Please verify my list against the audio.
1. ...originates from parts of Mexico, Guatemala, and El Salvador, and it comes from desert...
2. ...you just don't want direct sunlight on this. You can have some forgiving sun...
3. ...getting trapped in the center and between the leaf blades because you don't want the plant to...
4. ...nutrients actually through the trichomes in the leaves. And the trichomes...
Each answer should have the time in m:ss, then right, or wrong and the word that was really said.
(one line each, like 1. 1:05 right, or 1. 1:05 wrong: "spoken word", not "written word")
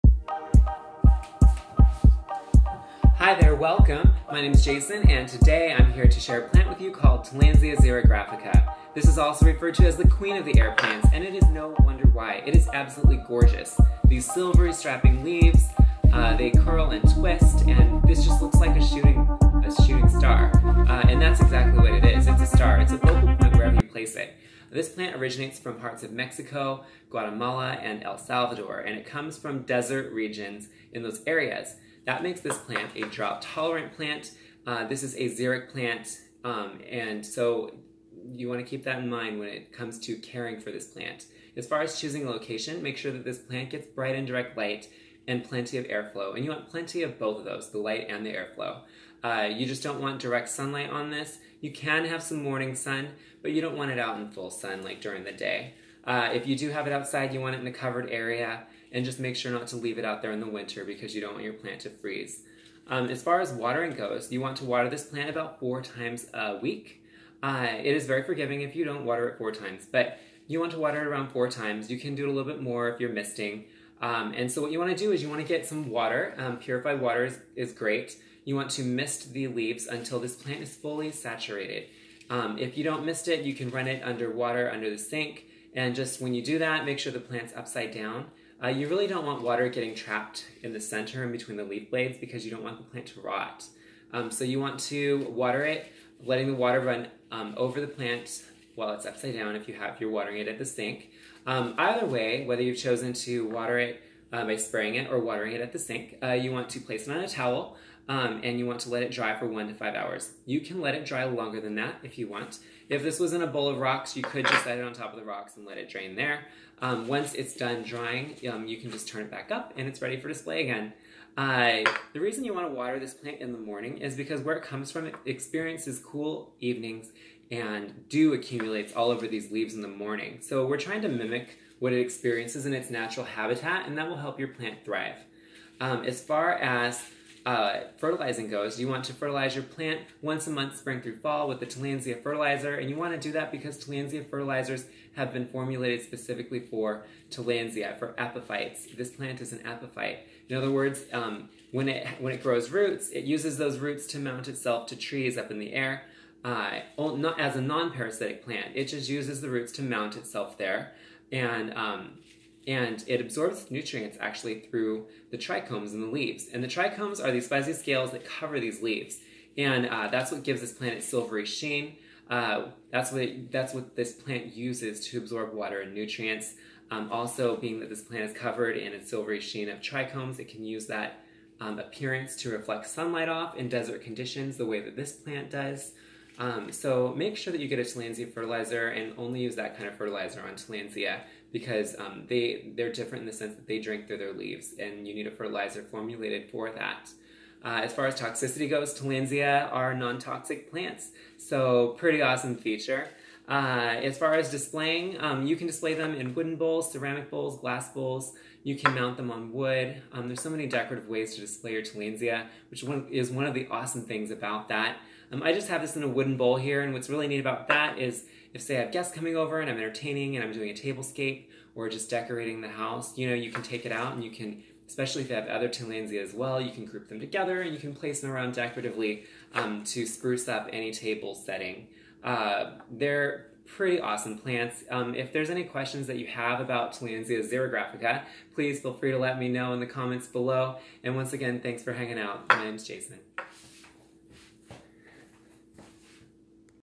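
1. 0:25 right
2. 0:49 wrong: "morning", not "forgiving"
3. 1:29 right
4. 2:43 right.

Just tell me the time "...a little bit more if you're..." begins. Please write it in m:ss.
1:12.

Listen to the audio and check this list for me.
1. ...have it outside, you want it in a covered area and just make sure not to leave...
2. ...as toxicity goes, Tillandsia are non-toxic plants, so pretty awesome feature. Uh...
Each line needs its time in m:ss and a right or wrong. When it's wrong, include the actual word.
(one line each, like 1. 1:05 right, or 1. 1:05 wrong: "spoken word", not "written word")
1. 0:56 right
2. 3:18 right.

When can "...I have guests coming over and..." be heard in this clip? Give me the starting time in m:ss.
3:38.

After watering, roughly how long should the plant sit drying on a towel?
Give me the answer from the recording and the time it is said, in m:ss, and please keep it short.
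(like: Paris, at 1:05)
1 to 5 hours, at 1:49.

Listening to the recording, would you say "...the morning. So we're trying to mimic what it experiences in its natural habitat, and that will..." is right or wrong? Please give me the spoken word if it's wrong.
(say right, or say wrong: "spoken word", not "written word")
right.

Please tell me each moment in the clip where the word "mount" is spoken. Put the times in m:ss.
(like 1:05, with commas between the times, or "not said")
2:34, 2:39, 3:28.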